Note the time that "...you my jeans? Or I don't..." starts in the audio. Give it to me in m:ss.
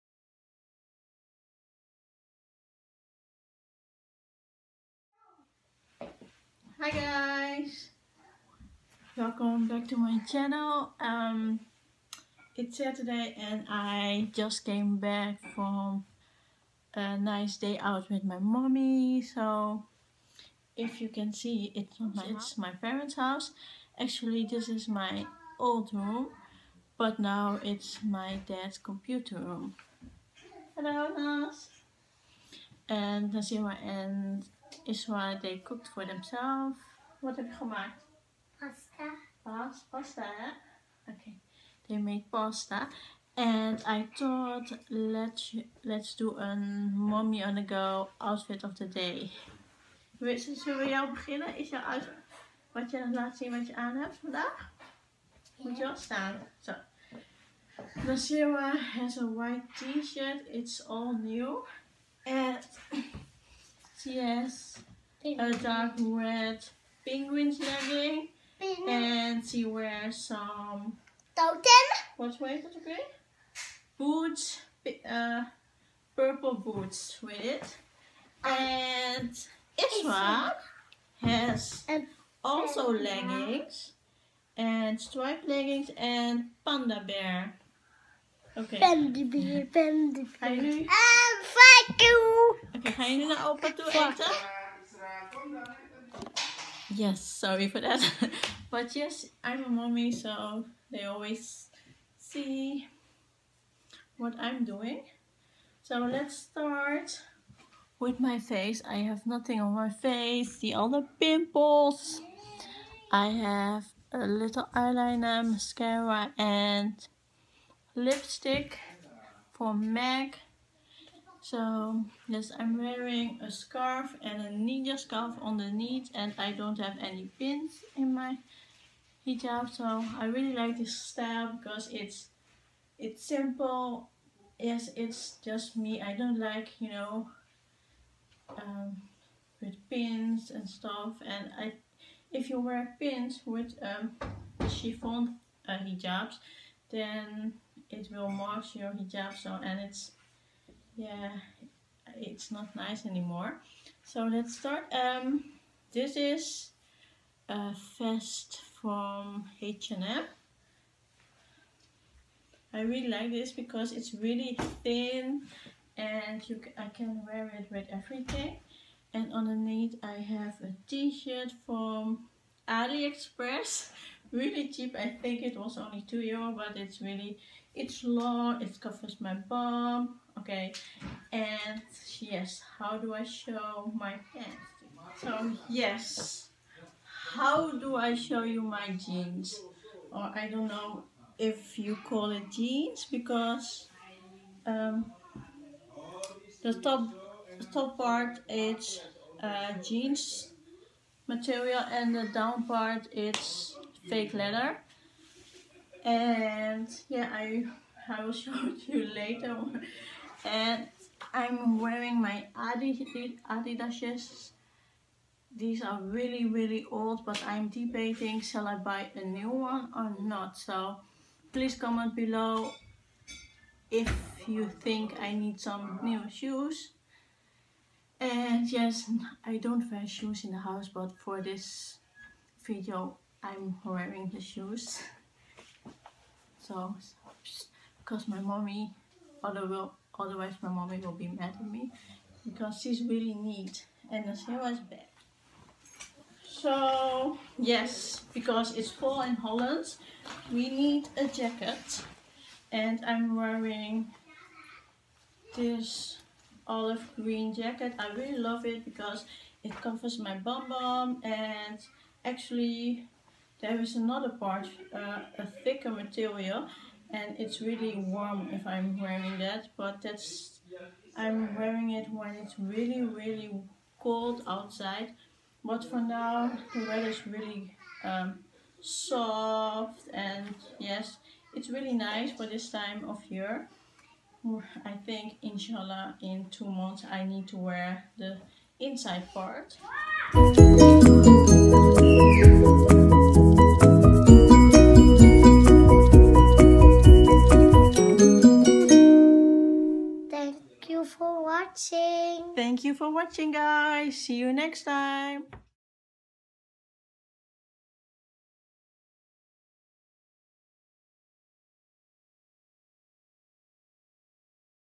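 3:08.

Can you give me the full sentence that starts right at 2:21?
And I, if you wear pins with um, chiffon uh, hijabs, then it will mark your hijab.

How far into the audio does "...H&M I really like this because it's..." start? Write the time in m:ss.
2:39.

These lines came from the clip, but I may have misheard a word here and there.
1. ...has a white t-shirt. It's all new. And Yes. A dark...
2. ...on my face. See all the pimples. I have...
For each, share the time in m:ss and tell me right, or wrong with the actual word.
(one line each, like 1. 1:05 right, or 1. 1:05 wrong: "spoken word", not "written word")
1. 0:58 right
2. 1:49 right.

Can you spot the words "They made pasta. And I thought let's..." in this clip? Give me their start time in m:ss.
0:41.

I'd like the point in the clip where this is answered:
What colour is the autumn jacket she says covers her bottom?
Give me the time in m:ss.
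4:16.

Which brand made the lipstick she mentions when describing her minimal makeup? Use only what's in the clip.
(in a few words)
MAC.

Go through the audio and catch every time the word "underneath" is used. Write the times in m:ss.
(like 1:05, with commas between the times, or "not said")
2:05, 2:49.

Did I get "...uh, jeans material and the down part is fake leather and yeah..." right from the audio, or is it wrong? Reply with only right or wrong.
right.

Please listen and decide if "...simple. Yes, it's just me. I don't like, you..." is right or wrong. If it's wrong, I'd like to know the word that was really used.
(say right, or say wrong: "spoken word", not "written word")
right.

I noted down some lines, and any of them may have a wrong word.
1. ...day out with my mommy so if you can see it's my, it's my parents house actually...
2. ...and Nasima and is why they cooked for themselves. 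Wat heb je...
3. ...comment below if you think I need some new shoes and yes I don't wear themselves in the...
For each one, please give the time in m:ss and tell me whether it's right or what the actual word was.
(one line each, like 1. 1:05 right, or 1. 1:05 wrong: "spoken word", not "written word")
1. 0:17 right
2. 0:32 right
3. 3:41 wrong: "shoes", not "themselves".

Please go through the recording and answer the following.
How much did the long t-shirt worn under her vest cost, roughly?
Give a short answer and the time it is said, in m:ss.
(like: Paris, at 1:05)
2 euro, at 2:56.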